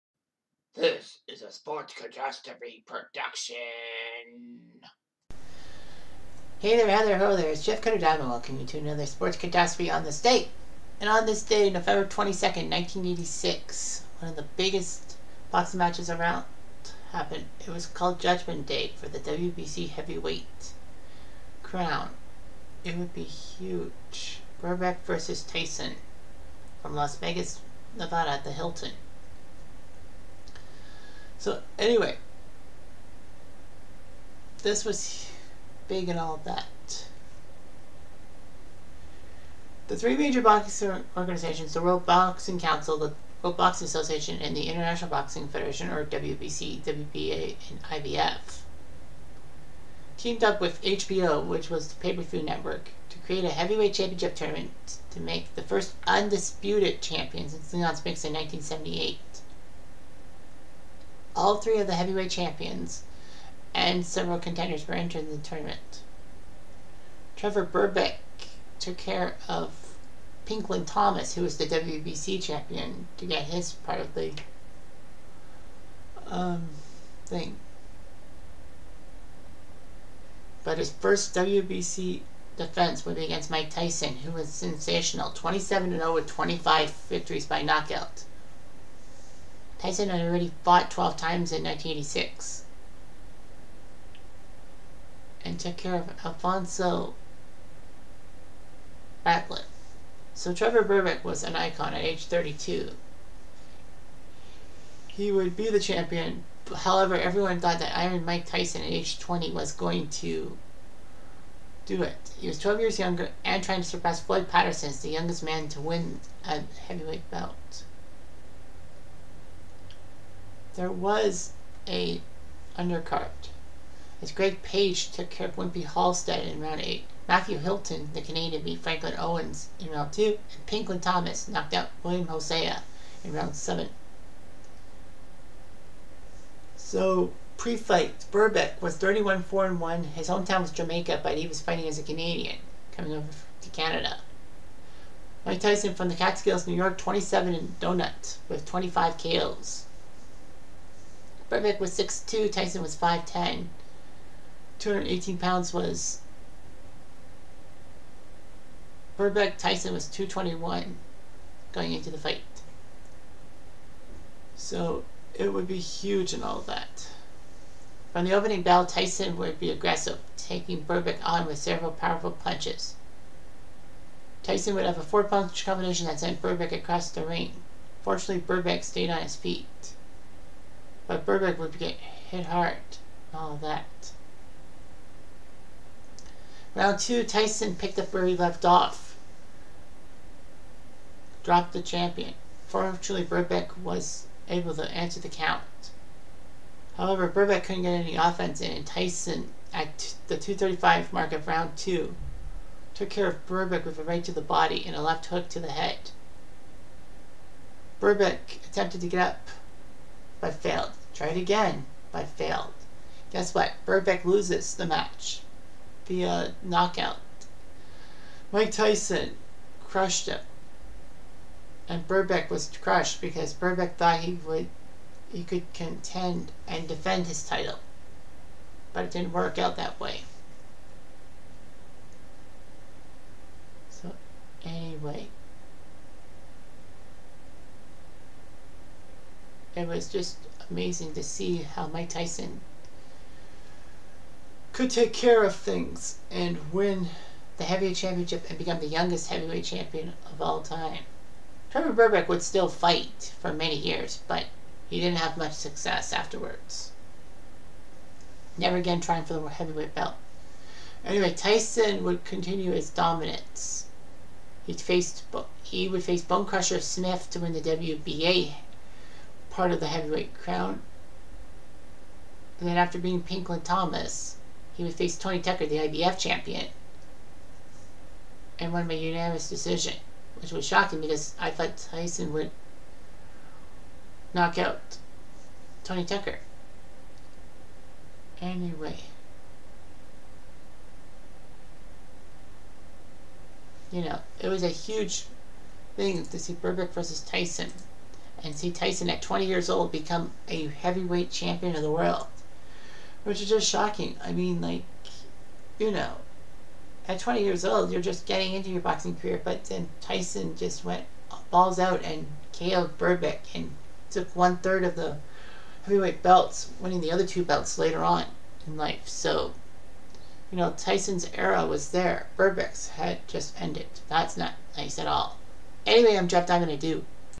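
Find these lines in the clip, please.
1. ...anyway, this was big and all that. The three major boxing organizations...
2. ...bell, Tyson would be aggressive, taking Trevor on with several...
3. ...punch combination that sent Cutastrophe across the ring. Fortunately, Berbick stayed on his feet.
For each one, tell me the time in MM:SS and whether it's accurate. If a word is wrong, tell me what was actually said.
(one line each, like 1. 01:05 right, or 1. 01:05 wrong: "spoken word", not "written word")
1. 00:31 right
2. 02:48 wrong: "Berbick", not "Trevor"
3. 02:55 wrong: "Berbick", not "Cutastrophe".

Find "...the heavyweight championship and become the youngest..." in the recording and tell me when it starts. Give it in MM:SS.
04:07.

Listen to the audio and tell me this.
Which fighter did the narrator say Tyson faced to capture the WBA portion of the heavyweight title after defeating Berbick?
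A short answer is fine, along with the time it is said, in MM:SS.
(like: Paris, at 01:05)
Bonecrusher Smith, at 04:26.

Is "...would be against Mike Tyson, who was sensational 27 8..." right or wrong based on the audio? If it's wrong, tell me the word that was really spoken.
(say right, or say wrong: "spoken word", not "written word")
wrong: "0", not "8".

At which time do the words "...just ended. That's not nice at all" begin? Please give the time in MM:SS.
05:23.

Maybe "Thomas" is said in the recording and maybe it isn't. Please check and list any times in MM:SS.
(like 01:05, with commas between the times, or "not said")
01:10, 02:11, 04:33.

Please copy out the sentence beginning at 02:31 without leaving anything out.
Berbick was 6'2", Tyson was 5'10".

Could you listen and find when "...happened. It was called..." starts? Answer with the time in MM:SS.
00:17.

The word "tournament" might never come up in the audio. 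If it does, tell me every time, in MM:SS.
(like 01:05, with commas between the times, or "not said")
00:54, 01:05.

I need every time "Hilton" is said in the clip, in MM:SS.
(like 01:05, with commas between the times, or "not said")
00:28, 02:07.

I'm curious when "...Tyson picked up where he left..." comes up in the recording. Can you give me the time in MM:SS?
03:07.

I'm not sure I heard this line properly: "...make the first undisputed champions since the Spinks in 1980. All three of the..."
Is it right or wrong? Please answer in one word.
wrong.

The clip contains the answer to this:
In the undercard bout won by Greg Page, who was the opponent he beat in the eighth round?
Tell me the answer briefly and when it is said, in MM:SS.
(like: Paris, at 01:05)
Wimpy Halstead, at 02:05.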